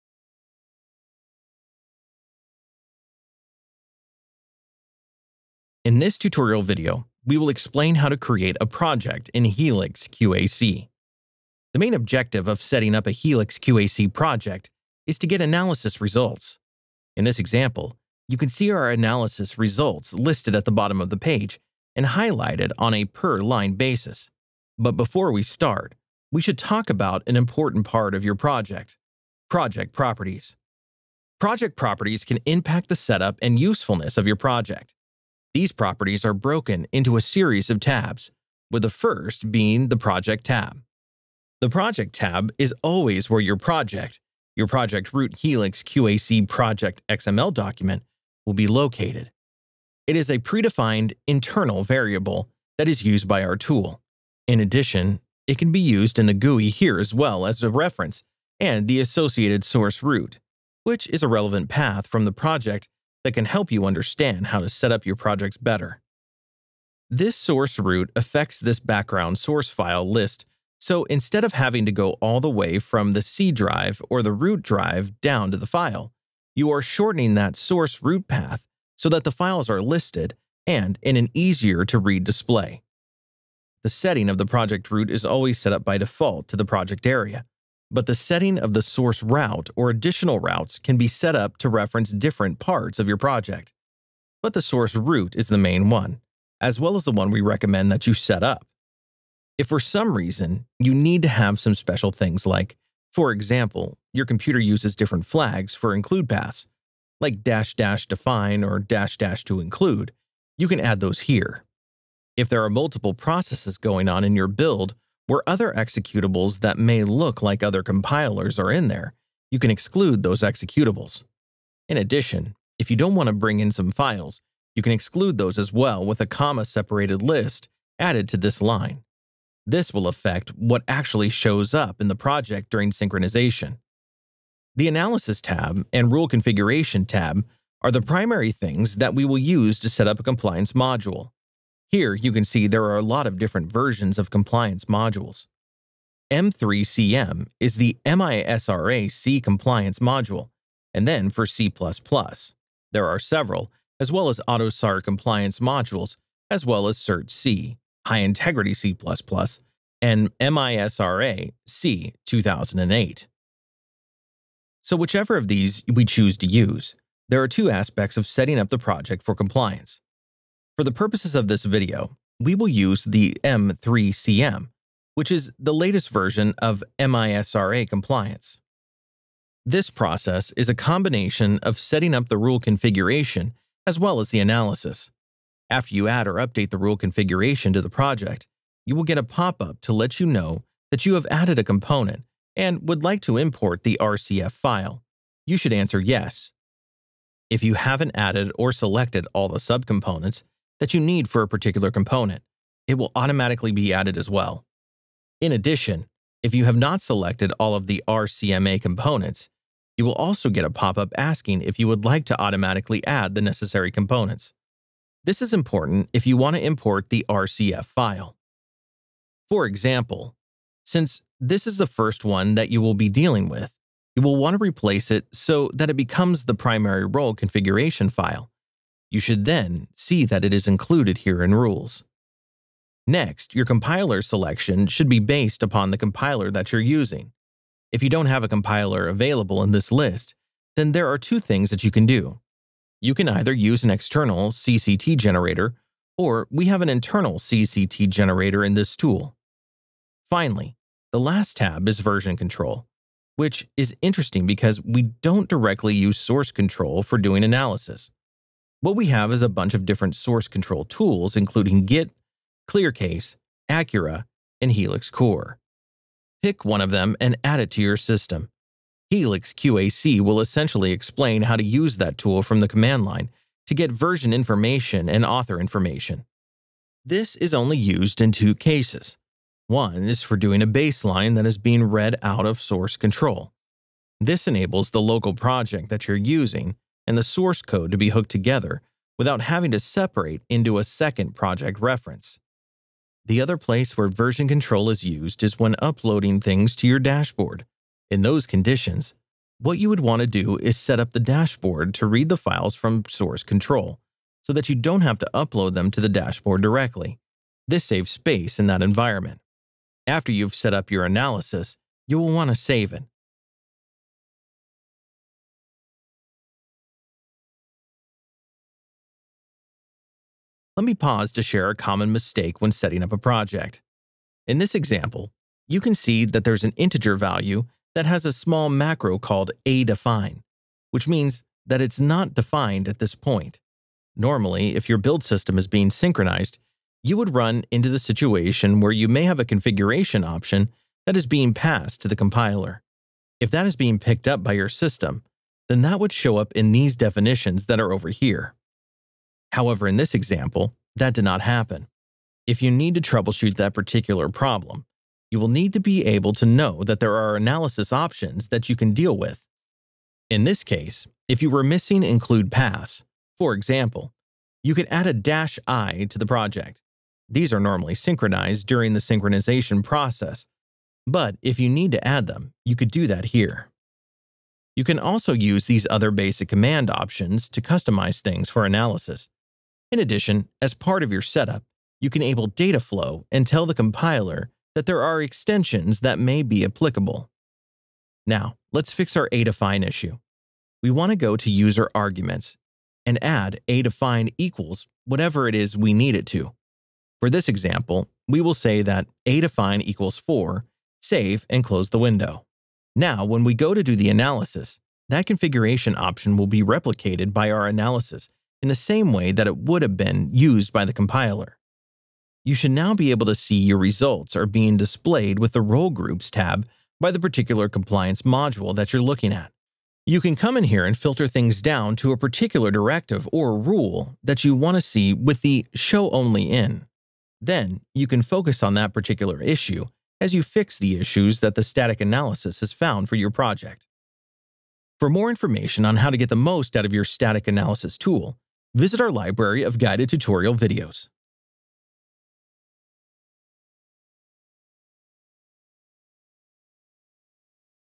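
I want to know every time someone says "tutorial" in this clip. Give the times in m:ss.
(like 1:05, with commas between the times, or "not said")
0:06, 7:20.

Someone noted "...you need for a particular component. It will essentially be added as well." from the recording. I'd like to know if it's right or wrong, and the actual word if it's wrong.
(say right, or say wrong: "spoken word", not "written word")
wrong: "automatically", not "essentially".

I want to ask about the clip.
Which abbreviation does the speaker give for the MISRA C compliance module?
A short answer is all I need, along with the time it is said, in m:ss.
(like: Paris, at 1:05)
M3CM, at 2:26.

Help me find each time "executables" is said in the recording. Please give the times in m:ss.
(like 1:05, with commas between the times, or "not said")
1:55, 2:00.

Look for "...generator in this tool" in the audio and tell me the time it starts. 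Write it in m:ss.
4:08.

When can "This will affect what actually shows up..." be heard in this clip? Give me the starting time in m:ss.
2:09.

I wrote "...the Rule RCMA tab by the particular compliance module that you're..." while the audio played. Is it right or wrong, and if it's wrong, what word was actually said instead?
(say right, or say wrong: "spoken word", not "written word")
wrong: "Groups", not "RCMA".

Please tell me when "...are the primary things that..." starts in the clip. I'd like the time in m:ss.
2:17.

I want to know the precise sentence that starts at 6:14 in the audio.
You can also use these other basic command options to customize things for analysis.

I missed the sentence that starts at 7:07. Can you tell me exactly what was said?
Then you can focus on that particular issue as you fix the issues that the static analysis has found for your project.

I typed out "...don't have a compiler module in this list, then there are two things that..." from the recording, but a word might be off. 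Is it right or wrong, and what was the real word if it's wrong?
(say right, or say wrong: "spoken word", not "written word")
wrong: "available", not "module".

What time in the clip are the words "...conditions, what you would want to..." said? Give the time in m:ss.
4:58.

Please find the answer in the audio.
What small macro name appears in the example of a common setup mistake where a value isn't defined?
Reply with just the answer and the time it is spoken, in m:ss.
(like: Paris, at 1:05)
aDefine, at 5:29.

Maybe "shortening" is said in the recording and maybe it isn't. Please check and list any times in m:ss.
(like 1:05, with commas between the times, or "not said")
1:16.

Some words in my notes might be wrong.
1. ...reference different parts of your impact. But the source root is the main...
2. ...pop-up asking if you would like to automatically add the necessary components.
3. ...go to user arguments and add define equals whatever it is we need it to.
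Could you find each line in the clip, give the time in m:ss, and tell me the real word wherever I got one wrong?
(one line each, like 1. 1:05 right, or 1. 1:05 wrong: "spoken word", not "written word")
1. 1:31 wrong: "project", not "impact"
2. 3:30 right
3. 6:31 right.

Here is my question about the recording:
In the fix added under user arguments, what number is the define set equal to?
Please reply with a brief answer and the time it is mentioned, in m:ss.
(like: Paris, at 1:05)
4, at 6:40.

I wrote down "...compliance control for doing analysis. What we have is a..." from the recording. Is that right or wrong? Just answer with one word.
wrong.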